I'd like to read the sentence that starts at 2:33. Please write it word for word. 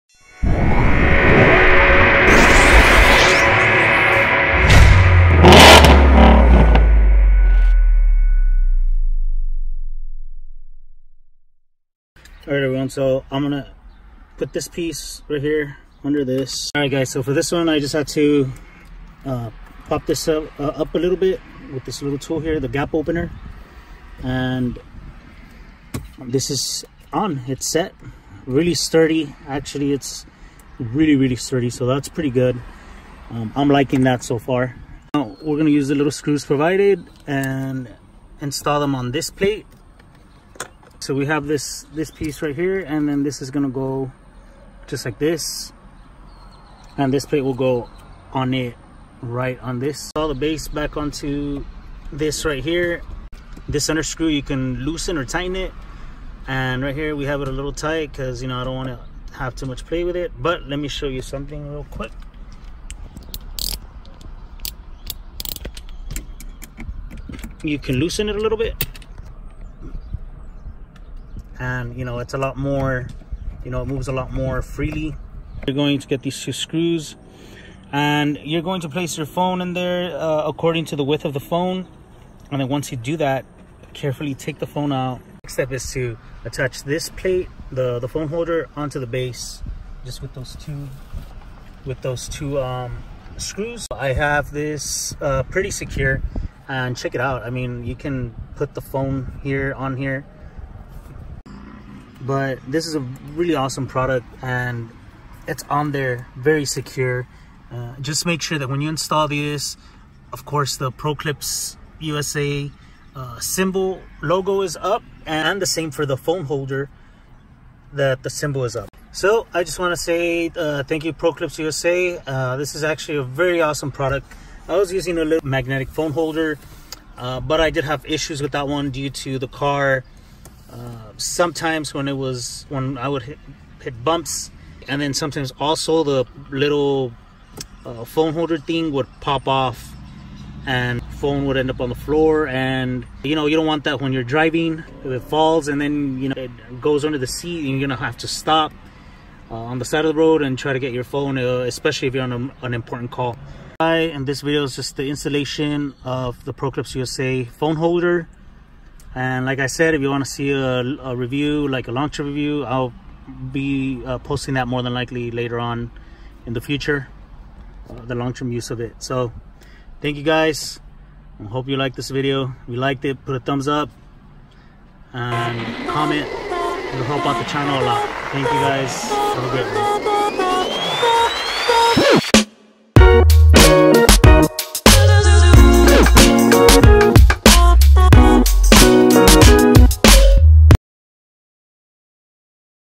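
Hi, and this video is just the installation of the Proclips USA phone holder.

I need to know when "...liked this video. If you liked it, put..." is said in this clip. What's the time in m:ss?
2:51.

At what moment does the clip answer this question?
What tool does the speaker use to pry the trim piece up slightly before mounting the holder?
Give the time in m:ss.
0:22.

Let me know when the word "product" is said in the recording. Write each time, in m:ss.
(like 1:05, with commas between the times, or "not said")
1:43, 2:03.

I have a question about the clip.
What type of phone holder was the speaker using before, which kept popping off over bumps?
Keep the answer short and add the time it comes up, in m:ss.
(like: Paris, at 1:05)
magnetic phone holder, at 2:05.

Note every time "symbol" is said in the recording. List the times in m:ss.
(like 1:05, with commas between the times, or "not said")
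1:53, 1:58.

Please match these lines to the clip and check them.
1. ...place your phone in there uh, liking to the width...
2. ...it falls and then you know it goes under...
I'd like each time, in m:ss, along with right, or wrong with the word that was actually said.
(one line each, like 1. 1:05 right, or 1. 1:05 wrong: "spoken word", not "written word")
1. 1:18 wrong: "according", not "liking"
2. 2:25 right.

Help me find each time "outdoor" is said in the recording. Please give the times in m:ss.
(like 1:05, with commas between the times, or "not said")
not said.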